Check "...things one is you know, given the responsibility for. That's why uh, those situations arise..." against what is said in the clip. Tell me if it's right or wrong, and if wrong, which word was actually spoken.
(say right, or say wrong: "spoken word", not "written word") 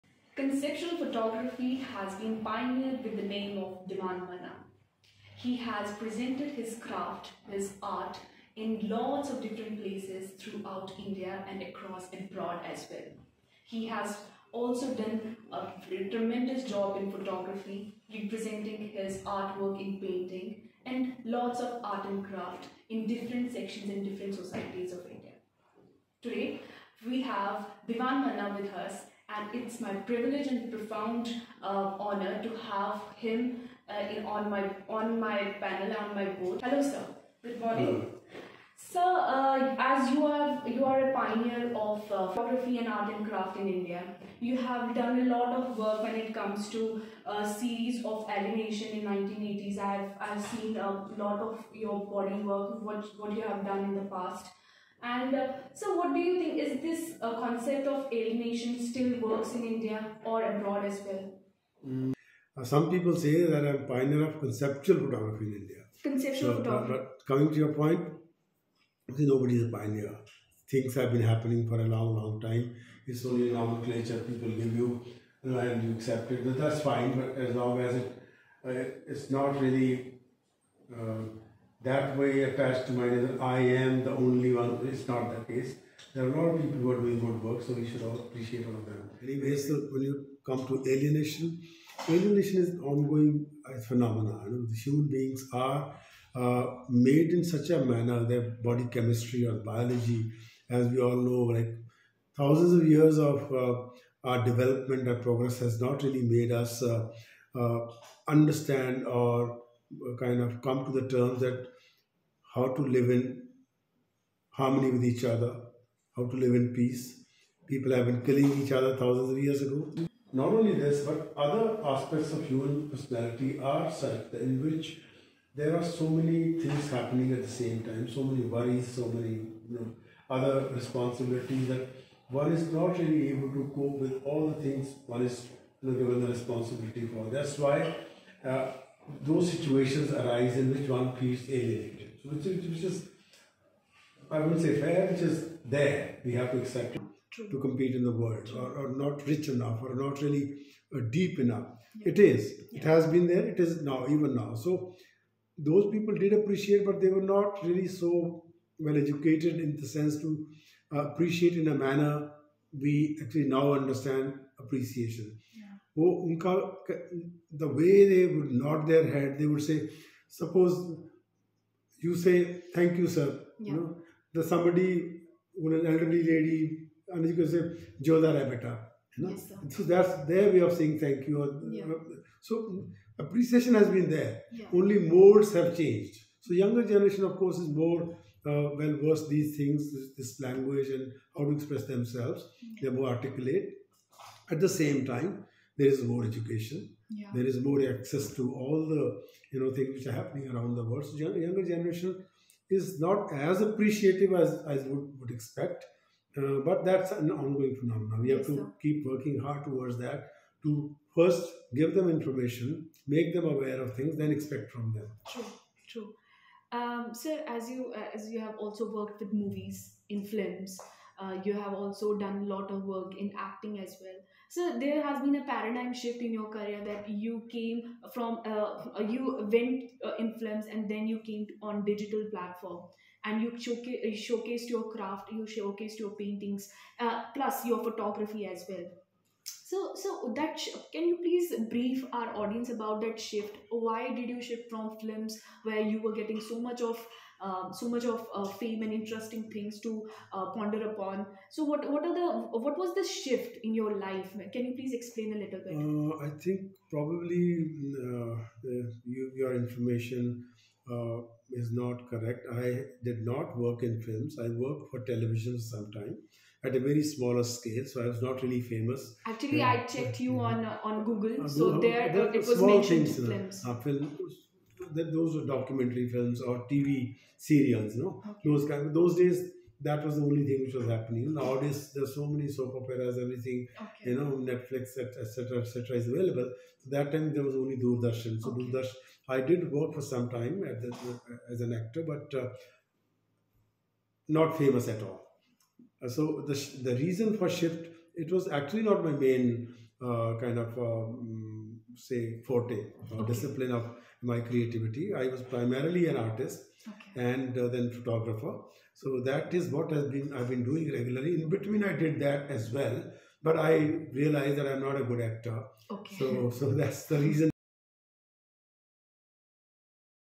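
right.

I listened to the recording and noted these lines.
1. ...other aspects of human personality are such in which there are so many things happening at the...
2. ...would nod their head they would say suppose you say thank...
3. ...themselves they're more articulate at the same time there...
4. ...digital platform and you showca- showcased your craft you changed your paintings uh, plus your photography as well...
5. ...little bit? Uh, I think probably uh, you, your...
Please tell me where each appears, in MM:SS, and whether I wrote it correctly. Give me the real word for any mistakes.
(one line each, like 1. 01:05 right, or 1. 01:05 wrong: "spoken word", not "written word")
1. 02:01 right
2. 02:48 right
3. 03:11 right
4. 03:51 wrong: "showcased", not "changed"
5. 04:15 right.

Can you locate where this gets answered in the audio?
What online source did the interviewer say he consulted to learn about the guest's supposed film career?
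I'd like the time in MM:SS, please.
04:31.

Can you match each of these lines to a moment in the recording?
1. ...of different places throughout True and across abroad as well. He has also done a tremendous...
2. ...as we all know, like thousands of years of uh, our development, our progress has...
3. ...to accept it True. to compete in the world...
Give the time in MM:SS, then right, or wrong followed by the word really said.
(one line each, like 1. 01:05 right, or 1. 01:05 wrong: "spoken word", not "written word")
1. 00:09 wrong: "India", not "True"
2. 01:40 right
3. 02:26 right.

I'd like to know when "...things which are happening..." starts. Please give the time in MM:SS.
03:19.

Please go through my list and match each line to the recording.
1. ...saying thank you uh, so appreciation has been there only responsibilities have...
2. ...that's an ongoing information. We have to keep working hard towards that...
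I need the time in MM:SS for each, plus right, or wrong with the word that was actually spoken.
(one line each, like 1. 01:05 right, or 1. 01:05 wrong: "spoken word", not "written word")
1. 03:00 wrong: "modes", not "responsibilities"
2. 03:26 wrong: "phenomenon", not "information".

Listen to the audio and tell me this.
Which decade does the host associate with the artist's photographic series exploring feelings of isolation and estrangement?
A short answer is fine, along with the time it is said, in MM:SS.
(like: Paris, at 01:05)
1980s, at 00:49.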